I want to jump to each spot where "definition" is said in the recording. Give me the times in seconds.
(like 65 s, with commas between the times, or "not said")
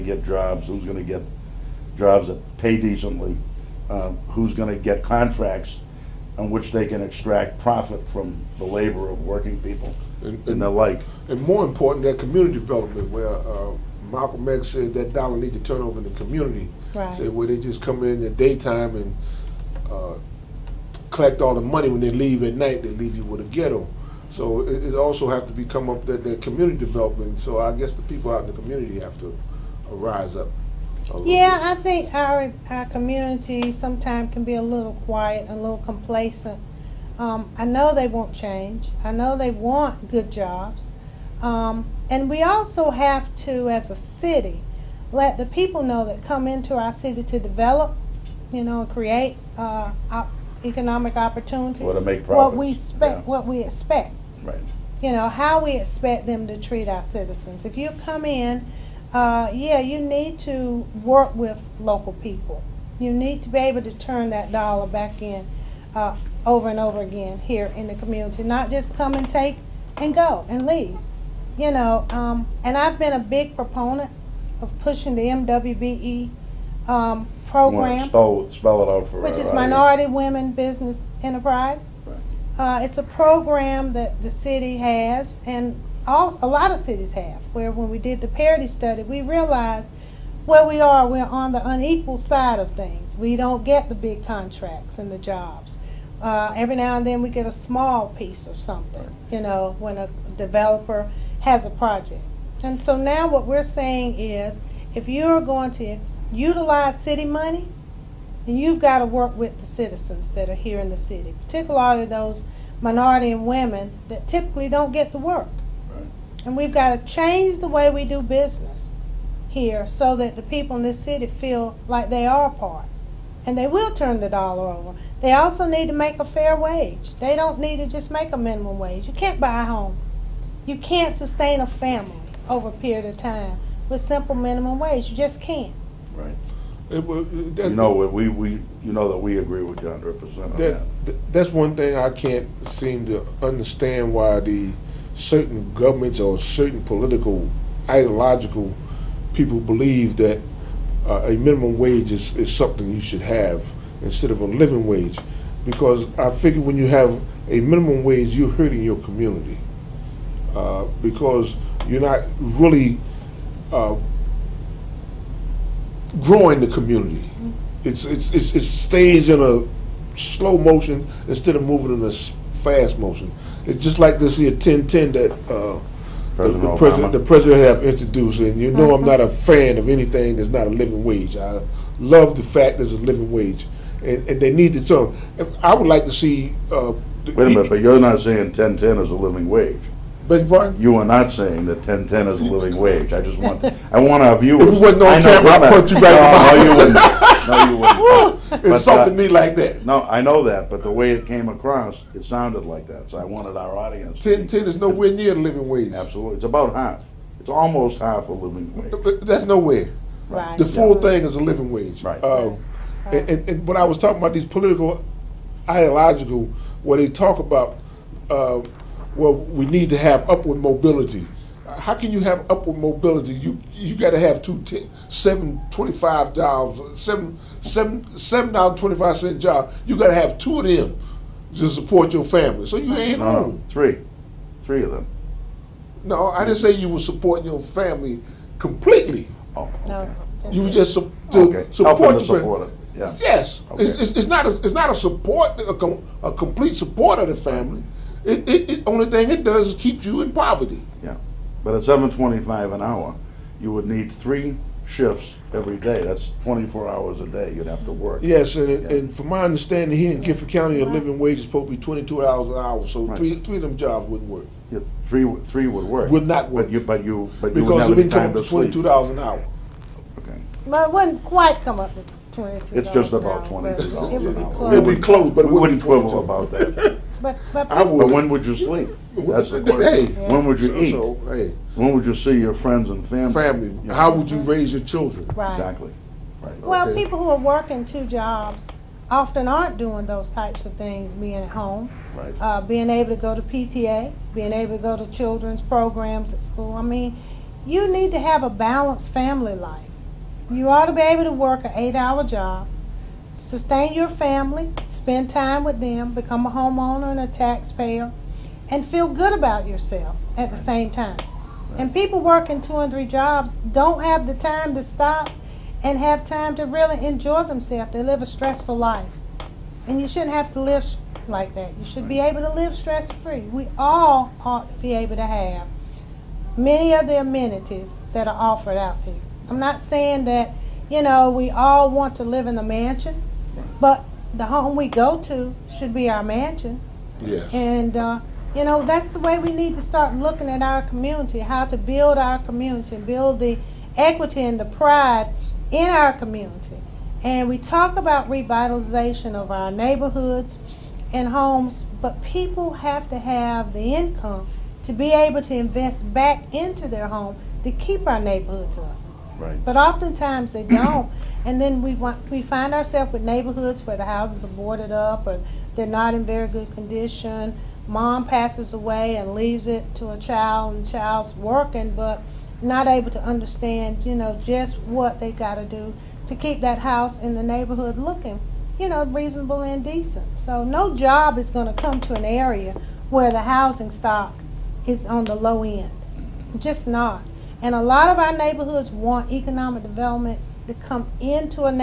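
not said.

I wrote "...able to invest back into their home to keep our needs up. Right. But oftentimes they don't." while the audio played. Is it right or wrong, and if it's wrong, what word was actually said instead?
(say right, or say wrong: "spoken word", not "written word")
wrong: "neighborhoods", not "needs".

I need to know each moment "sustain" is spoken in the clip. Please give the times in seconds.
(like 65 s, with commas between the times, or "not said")
131 s, 303 s.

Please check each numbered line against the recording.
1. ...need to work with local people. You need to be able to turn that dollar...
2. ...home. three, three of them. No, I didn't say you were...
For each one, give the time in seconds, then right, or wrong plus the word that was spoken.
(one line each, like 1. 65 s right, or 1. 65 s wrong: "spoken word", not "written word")
1. 59 s right
2. 233 s right.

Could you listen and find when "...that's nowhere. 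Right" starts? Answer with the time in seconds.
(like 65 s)
209 s.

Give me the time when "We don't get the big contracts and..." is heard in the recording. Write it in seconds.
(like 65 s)
93 s.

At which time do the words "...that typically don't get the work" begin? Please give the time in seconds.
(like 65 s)
114 s.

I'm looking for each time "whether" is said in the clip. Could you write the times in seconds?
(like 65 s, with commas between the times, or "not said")
not said.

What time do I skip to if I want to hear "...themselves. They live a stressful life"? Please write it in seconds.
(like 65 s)
317 s.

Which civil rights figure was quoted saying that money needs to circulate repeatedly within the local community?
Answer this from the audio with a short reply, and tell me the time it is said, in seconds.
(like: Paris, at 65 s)
Malcolm X, at 14 s.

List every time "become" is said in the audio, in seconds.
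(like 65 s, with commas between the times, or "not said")
25 s, 306 s.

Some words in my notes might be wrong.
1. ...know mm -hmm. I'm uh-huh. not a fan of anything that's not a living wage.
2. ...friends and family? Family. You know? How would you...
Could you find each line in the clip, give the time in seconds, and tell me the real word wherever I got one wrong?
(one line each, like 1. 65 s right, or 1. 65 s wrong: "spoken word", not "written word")
1. 178 s right
2. 282 s right.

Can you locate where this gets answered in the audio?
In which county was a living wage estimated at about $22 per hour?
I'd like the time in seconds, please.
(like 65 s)
260 s.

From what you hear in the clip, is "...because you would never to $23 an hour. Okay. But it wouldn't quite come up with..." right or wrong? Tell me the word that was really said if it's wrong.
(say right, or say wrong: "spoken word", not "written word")
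wrong: "22", not "23".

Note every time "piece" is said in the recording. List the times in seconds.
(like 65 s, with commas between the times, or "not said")
98 s.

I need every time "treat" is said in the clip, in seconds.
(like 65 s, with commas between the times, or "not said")
56 s.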